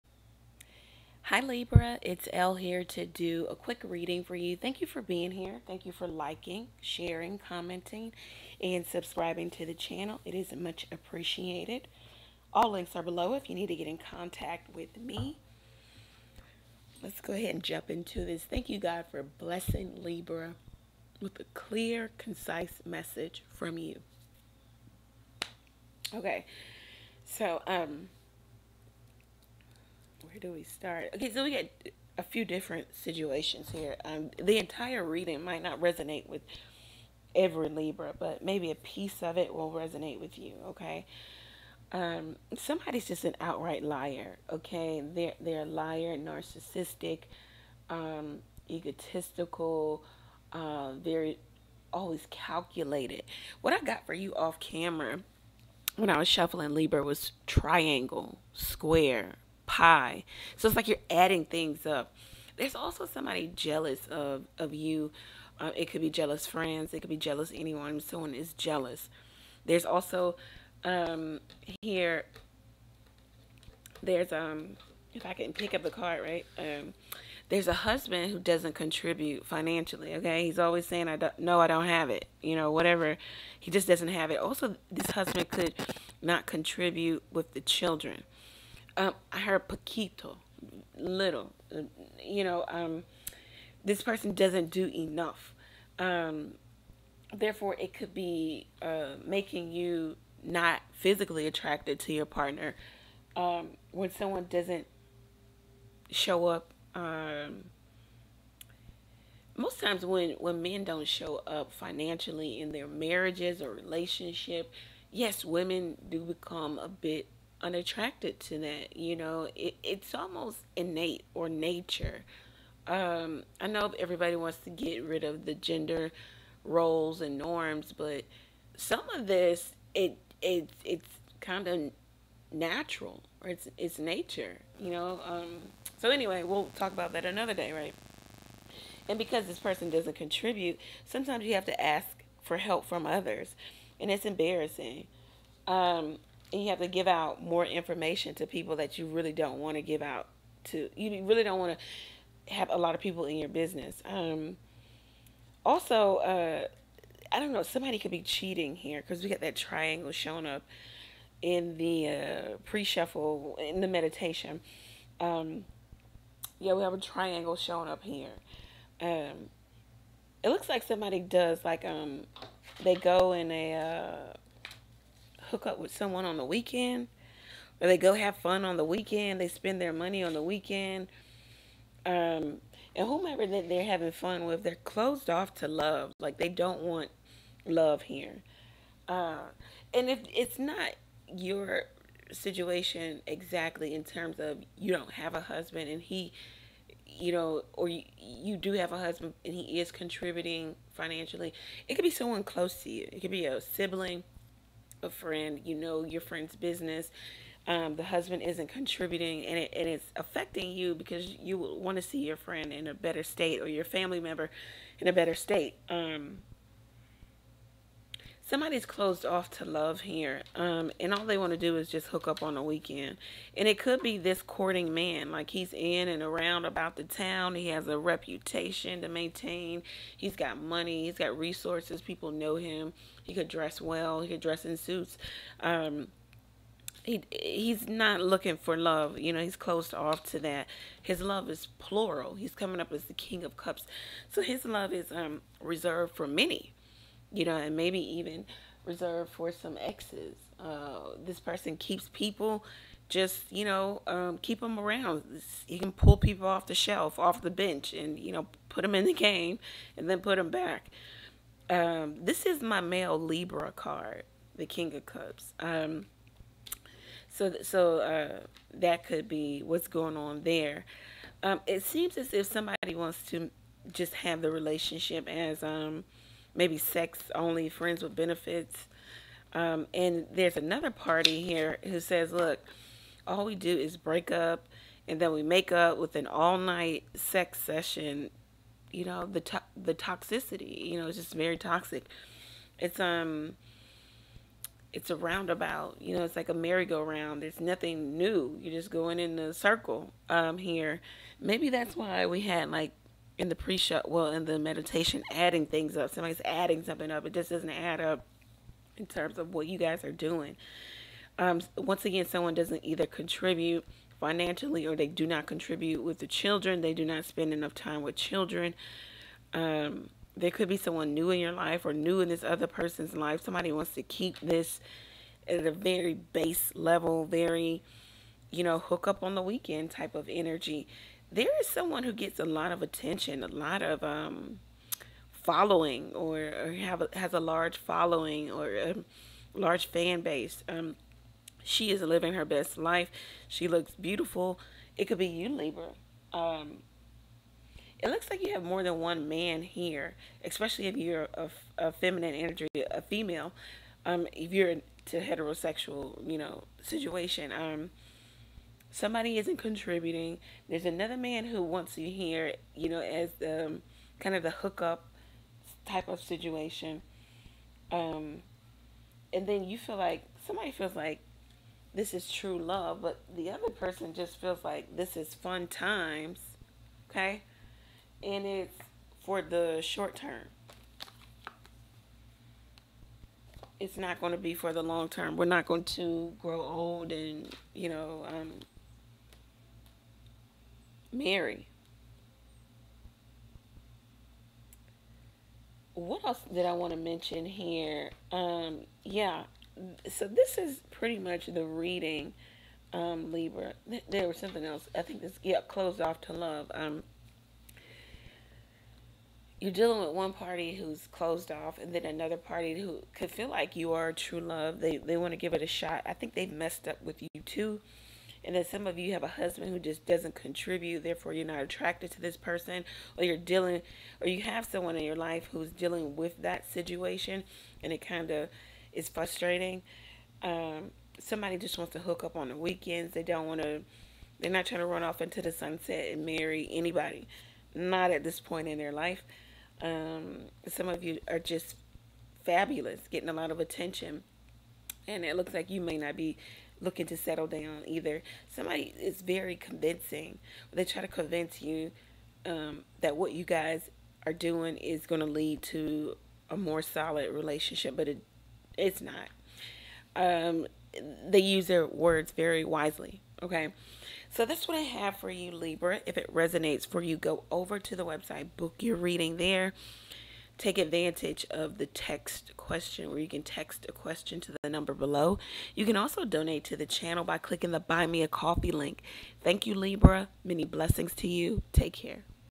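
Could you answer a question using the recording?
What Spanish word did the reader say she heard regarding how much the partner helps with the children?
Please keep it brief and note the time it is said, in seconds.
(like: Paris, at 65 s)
poquito, at 89 s.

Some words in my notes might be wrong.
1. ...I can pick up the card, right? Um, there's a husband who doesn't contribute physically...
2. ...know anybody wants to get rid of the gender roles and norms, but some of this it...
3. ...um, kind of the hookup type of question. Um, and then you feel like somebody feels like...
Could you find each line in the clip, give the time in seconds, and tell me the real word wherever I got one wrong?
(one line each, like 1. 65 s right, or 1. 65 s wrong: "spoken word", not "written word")
1. 75 s wrong: "financially", not "physically"
2. 123 s wrong: "everybody", not "anybody"
3. 363 s wrong: "situation", not "question".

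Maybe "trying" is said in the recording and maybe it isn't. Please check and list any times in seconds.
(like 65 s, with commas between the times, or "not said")
434 s.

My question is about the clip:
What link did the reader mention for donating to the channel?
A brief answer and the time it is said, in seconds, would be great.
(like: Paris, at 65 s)
Buy Me a Coffee, at 477 s.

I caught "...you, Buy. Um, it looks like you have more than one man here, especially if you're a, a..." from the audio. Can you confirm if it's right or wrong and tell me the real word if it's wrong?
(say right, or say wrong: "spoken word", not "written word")
wrong: "Libra", not "Buy".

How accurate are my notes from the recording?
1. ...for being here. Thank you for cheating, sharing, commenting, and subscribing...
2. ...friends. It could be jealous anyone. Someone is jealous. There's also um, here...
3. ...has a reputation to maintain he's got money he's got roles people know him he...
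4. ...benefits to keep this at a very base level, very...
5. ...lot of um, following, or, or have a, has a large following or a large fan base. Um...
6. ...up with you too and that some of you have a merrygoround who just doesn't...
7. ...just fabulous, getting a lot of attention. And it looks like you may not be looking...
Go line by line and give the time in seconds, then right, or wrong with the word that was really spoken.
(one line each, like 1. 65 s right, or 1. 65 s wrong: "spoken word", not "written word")
1. 4 s wrong: "liking", not "cheating"
2. 66 s right
3. 227 s wrong: "resources", not "roles"
4. 323 s wrong: "wants", not "benefits"
5. 333 s right
6. 416 s wrong: "husband", not "merrygoround"
7. 441 s right.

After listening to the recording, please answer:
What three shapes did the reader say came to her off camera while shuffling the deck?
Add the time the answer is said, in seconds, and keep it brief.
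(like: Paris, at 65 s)
triangle, square, pie, at 57 s.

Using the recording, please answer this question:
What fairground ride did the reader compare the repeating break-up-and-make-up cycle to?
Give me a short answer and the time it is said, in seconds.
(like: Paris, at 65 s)
merry-go-round, at 296 s.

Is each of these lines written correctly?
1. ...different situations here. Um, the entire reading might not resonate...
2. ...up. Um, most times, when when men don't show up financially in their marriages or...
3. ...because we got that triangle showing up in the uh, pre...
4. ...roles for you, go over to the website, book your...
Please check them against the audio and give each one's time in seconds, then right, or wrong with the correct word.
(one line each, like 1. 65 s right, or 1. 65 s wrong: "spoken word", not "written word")
1. 32 s right
2. 106 s right
3. 159 s right
4. 466 s wrong: "resonates", not "roles".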